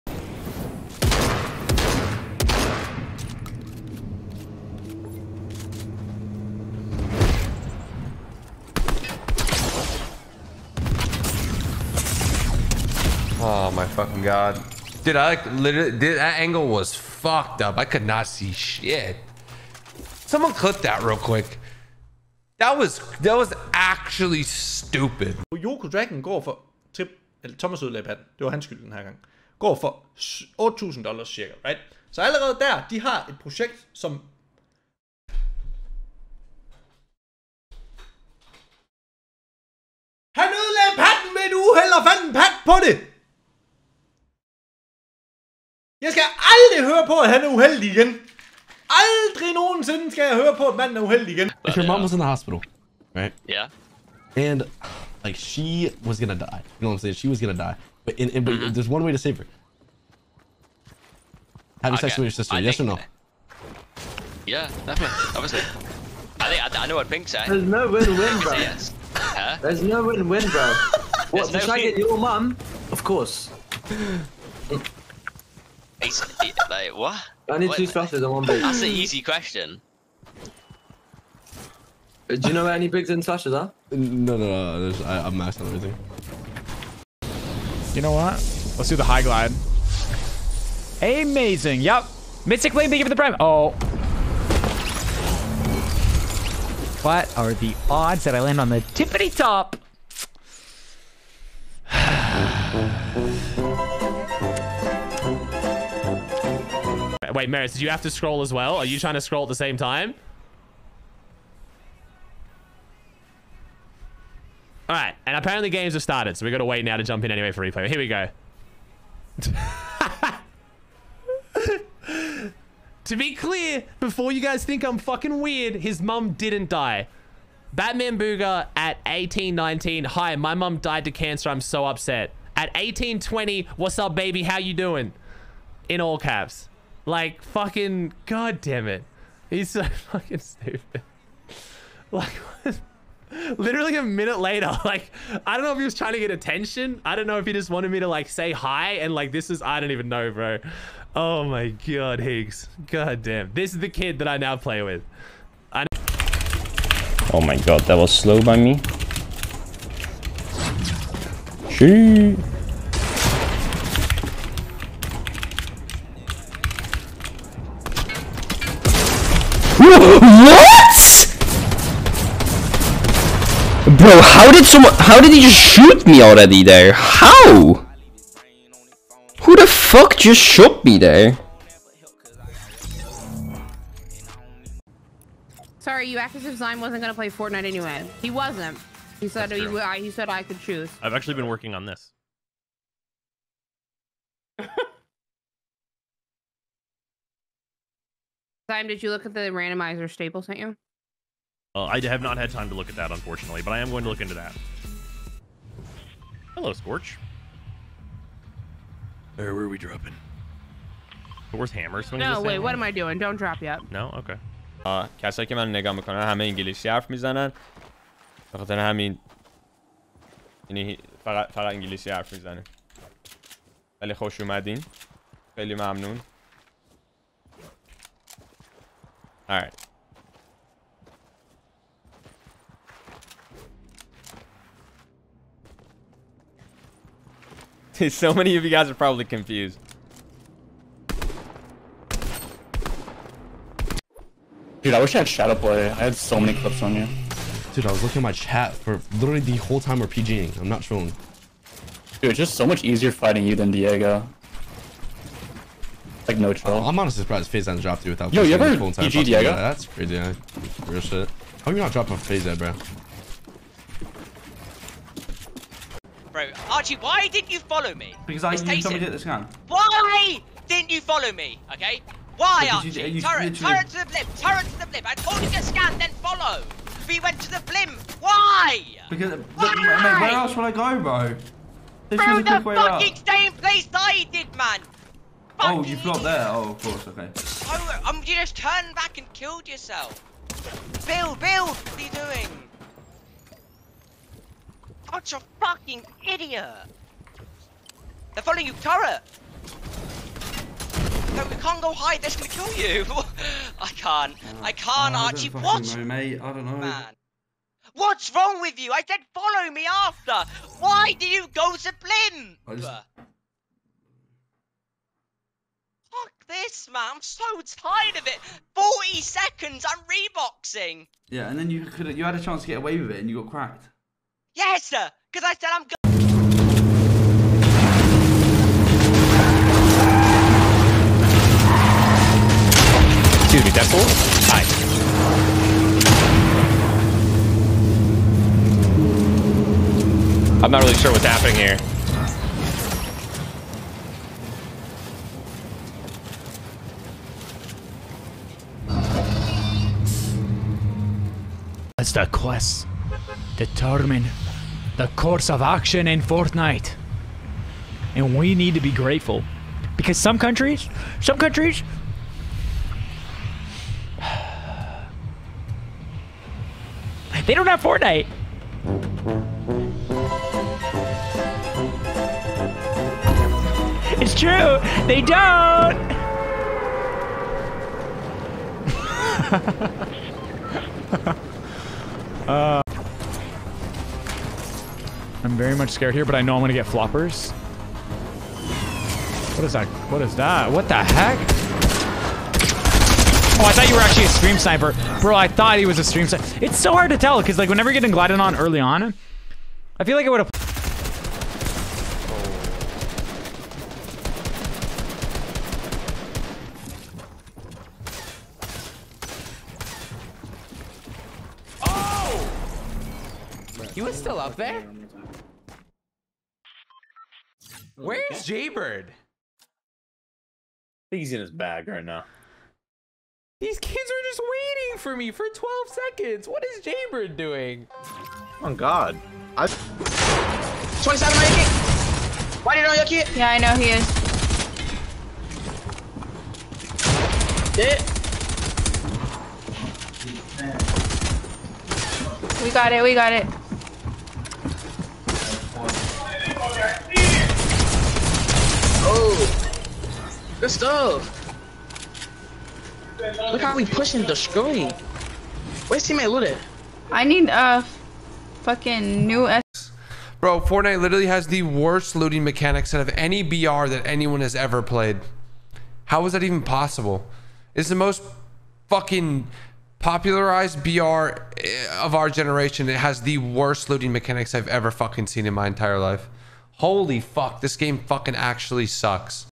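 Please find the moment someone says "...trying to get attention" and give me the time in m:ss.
2:25.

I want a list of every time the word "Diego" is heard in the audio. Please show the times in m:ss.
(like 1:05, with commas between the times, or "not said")
4:13, 4:19.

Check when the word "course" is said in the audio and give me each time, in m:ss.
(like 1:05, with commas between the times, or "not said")
1:13, 4:46, 5:55.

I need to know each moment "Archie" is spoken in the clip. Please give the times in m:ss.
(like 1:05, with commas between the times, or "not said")
4:26, 4:32, 5:05.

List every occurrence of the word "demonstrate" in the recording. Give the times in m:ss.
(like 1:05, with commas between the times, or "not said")
not said.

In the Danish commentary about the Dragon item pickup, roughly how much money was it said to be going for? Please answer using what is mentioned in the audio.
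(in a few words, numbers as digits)
$8,000.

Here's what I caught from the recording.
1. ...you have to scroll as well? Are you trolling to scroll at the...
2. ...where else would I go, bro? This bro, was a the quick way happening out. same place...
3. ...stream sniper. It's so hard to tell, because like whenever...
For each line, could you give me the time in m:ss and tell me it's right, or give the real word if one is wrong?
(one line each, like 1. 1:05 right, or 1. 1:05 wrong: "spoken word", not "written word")
1. 1:47 wrong: "trying", not "trolling"
2. 4:40 wrong: "fucking", not "happening"
3. 6:36 right.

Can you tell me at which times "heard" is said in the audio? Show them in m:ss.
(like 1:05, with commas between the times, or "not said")
not said.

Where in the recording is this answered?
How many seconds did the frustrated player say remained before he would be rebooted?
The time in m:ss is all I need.
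5:18.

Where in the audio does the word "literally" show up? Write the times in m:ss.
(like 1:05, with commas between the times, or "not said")
0:15, 2:23, 4:09, 4:33, 7:41.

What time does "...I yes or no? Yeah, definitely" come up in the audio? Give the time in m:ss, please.
1:02.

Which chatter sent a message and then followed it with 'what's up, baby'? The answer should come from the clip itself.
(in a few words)
Batman Booger.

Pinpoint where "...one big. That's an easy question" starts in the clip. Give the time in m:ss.
1:18.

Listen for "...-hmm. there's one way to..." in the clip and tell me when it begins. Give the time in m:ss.
0:58.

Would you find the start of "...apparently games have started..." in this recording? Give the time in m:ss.
1:55.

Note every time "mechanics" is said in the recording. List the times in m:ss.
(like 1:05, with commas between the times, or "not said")
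7:42, 7:54.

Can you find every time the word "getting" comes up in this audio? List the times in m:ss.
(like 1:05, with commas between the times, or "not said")
6:37.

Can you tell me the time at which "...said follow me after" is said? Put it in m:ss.
5:09.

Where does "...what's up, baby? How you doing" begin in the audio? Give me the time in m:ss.
2:13.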